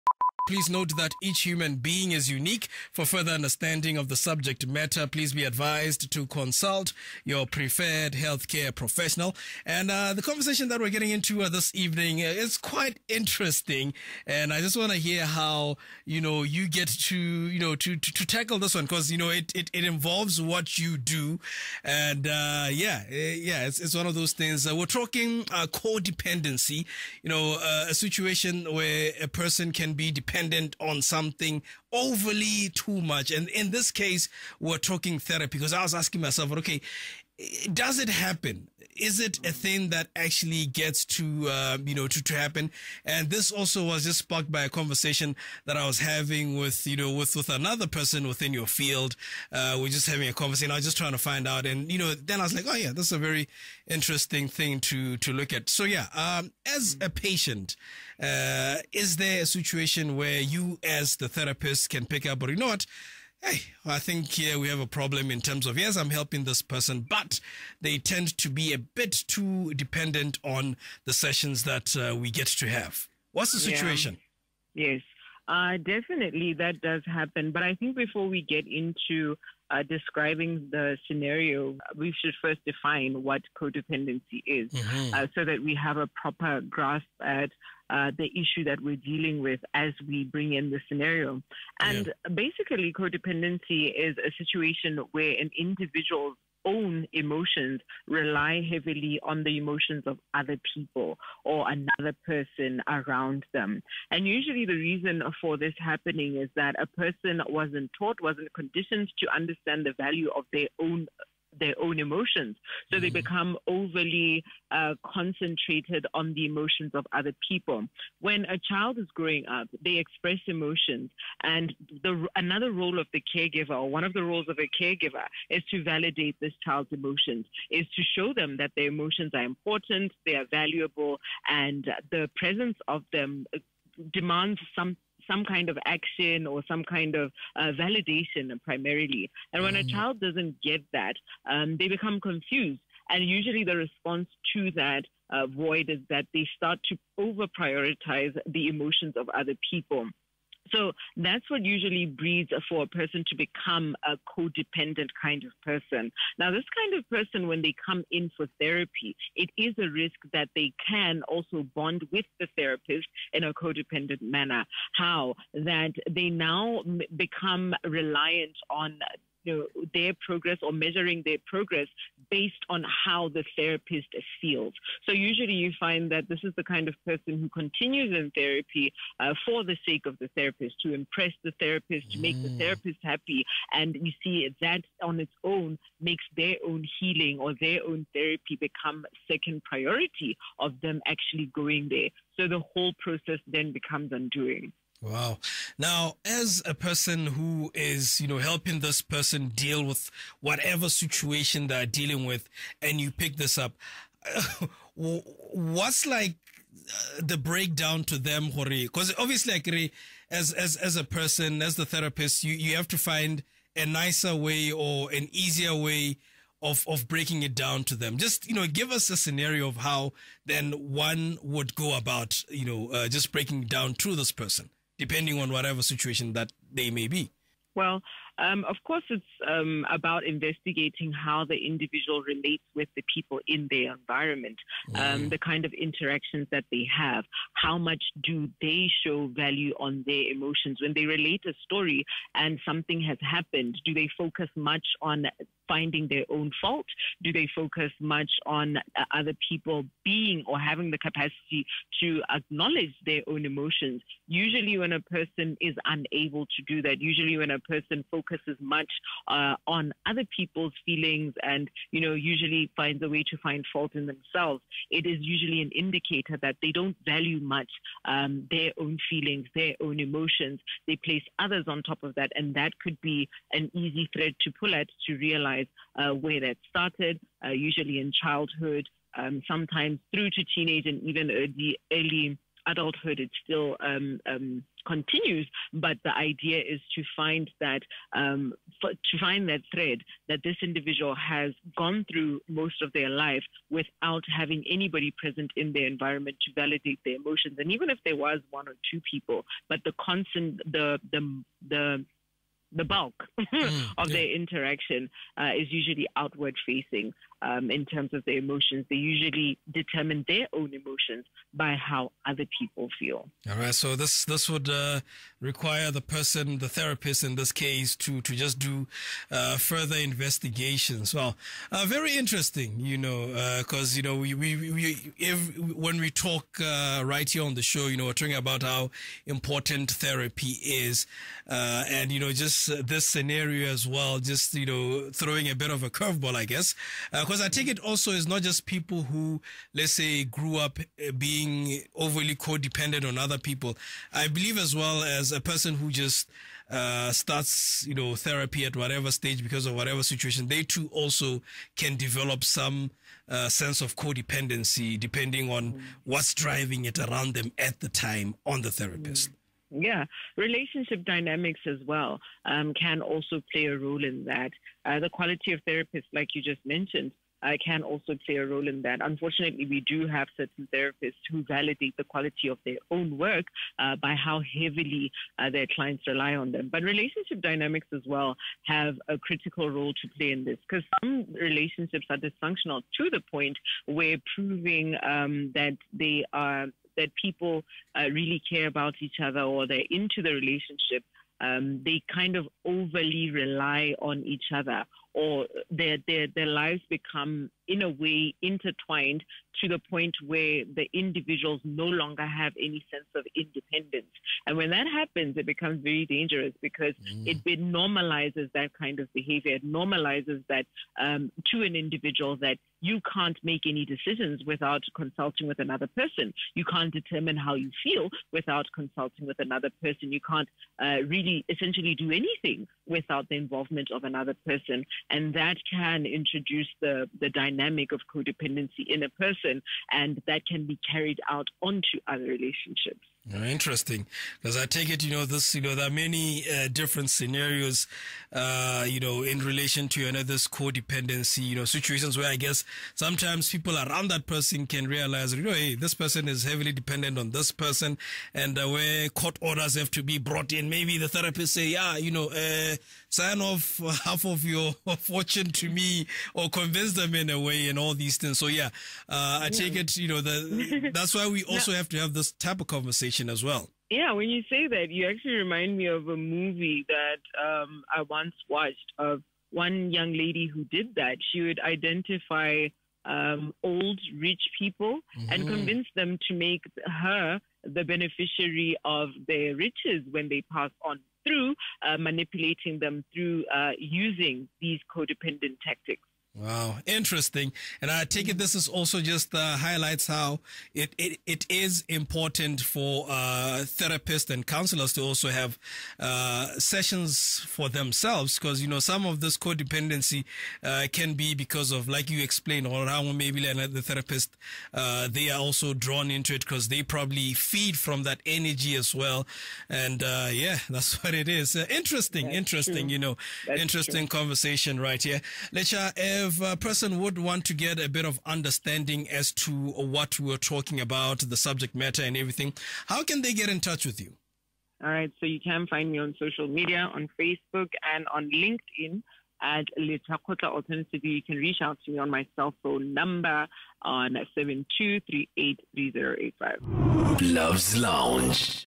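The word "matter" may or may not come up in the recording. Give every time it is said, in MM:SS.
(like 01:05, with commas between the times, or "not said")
00:04, 08:41.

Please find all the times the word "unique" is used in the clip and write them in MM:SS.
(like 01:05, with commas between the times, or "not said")
00:02.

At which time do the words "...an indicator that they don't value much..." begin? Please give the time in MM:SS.
04:25.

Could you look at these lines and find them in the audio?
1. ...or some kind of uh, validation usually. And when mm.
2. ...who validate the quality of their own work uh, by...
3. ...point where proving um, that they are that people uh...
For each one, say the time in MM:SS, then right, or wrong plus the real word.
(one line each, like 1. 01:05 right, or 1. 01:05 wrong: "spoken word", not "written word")
1. 02:16 wrong: "primarily", not "usually"
2. 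06:11 right
3. 06:23 right.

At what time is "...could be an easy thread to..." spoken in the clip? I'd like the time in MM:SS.
04:32.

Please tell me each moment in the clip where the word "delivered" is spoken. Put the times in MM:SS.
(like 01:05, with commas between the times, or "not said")
not said.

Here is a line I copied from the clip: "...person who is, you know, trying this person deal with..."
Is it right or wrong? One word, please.
wrong.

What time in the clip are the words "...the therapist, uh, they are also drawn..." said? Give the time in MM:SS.
08:23.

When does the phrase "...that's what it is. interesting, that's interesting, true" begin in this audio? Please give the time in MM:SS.
08:30.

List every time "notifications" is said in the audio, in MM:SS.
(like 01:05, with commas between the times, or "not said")
not said.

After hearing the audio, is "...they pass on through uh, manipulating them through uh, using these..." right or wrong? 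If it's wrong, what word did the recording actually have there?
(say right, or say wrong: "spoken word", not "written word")
right.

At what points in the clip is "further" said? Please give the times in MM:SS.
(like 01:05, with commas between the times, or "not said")
00:03, 05:19.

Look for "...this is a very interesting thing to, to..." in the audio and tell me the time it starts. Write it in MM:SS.
00:52.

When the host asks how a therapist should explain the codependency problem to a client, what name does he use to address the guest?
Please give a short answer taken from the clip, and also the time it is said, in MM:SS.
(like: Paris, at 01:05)
Hori, at 03:28.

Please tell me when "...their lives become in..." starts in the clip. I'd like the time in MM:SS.
06:36.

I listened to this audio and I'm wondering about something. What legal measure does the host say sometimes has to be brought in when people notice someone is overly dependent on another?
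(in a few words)
court orders.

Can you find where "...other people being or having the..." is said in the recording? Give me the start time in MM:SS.
04:09.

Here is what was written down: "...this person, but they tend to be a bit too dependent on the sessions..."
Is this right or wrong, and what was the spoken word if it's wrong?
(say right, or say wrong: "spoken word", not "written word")
right.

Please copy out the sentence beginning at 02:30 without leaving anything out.
So that's what usually breeds for a person to become a codependent kind of person.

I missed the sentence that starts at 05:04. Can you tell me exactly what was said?
their interaction uh, is usually outward facing um, in terms of their emotions.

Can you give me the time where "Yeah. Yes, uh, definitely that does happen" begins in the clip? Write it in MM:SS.
01:14.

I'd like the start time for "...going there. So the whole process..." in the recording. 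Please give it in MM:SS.
03:11.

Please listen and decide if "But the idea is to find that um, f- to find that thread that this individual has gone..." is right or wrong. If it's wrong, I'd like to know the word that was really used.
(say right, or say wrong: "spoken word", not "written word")
right.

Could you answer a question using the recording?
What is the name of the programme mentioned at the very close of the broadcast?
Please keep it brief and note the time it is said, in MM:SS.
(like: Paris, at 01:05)
Luv's Lounge, at 08:57.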